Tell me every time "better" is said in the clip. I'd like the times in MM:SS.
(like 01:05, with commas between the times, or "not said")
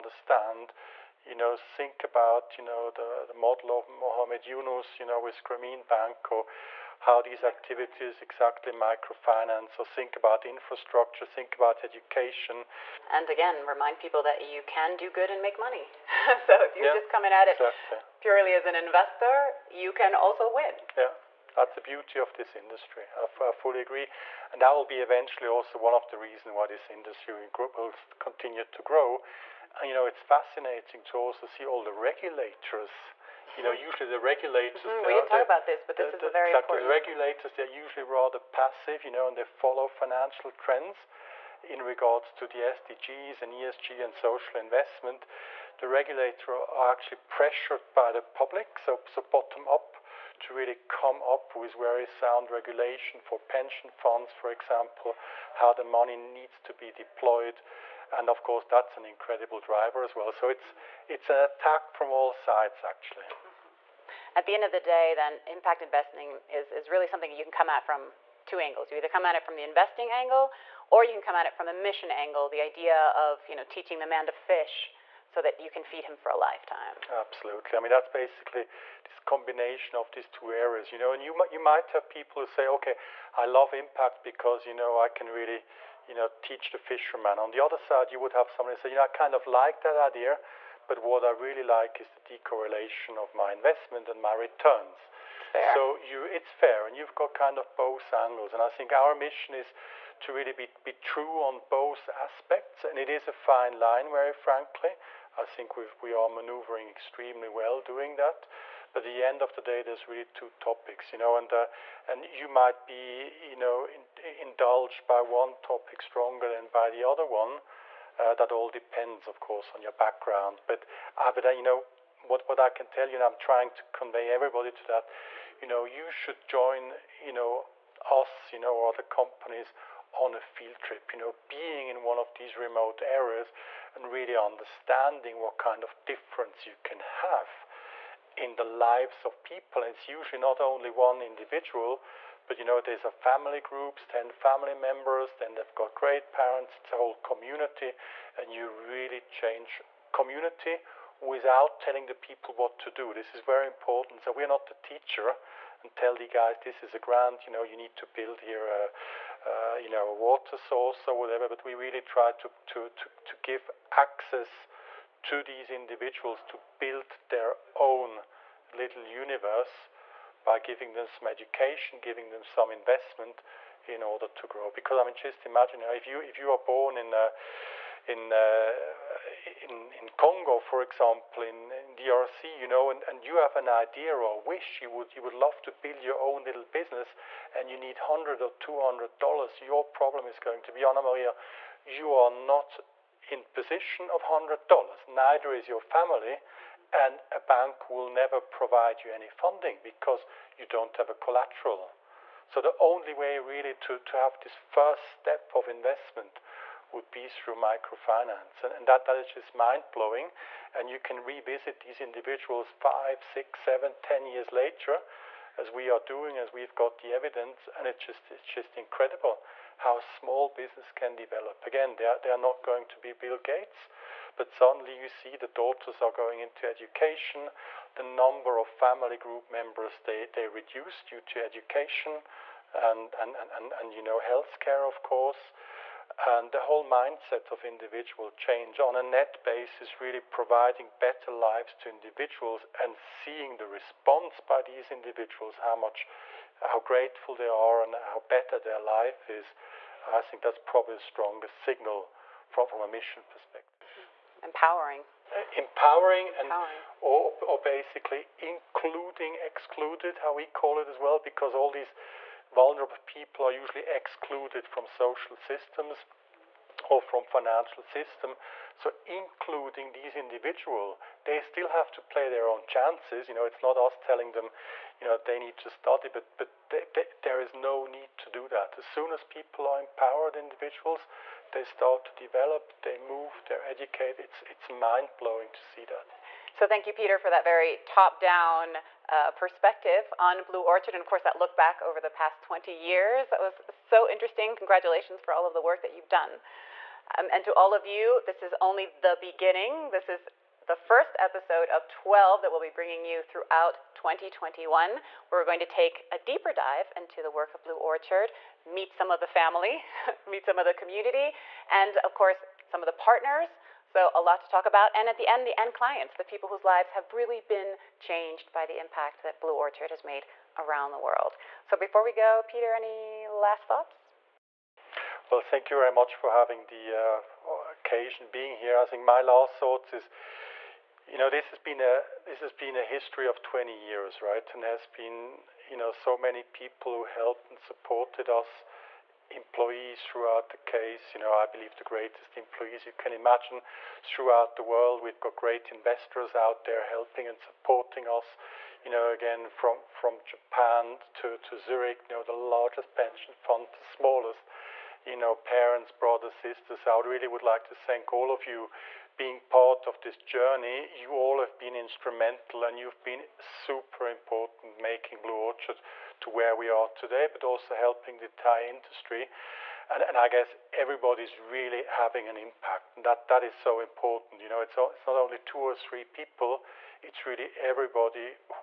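04:00, 04:08.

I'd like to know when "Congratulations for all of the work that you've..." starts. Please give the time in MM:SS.
04:54.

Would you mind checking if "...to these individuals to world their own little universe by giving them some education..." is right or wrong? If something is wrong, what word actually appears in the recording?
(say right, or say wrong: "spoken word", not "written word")
wrong: "build", not "world".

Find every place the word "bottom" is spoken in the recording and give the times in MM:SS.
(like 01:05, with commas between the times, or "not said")
00:49.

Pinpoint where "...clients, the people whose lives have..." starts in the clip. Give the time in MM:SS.
05:15.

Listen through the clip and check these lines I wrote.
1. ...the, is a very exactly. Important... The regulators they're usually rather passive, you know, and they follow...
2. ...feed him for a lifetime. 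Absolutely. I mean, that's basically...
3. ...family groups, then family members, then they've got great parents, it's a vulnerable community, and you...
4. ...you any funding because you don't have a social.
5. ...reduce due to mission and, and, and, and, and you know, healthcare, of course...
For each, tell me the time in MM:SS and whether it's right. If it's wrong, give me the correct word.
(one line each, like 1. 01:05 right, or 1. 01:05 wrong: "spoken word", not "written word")
1. 00:36 right
2. 01:15 right
3. 02:23 wrong: "whole", not "vulnerable"
4. 03:19 wrong: "collateral", not "social"
5. 03:50 wrong: "education", not "mission".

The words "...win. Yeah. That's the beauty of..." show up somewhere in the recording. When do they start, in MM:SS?
00:20.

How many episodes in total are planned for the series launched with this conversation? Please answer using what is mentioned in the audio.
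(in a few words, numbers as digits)
12.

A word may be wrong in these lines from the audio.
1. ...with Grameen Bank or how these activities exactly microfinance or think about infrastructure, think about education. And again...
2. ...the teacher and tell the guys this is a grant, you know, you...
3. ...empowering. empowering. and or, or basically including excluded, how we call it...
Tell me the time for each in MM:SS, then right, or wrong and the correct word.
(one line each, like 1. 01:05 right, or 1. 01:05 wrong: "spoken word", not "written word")
1. 00:05 right
2. 02:34 right
3. 04:15 right.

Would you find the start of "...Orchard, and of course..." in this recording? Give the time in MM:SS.
04:50.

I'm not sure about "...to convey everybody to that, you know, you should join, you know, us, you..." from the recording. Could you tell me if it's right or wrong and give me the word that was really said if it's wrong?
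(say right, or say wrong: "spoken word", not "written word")
right.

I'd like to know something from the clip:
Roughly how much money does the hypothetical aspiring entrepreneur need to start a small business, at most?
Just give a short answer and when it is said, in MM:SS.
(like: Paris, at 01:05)
200 dollars, at 03:08.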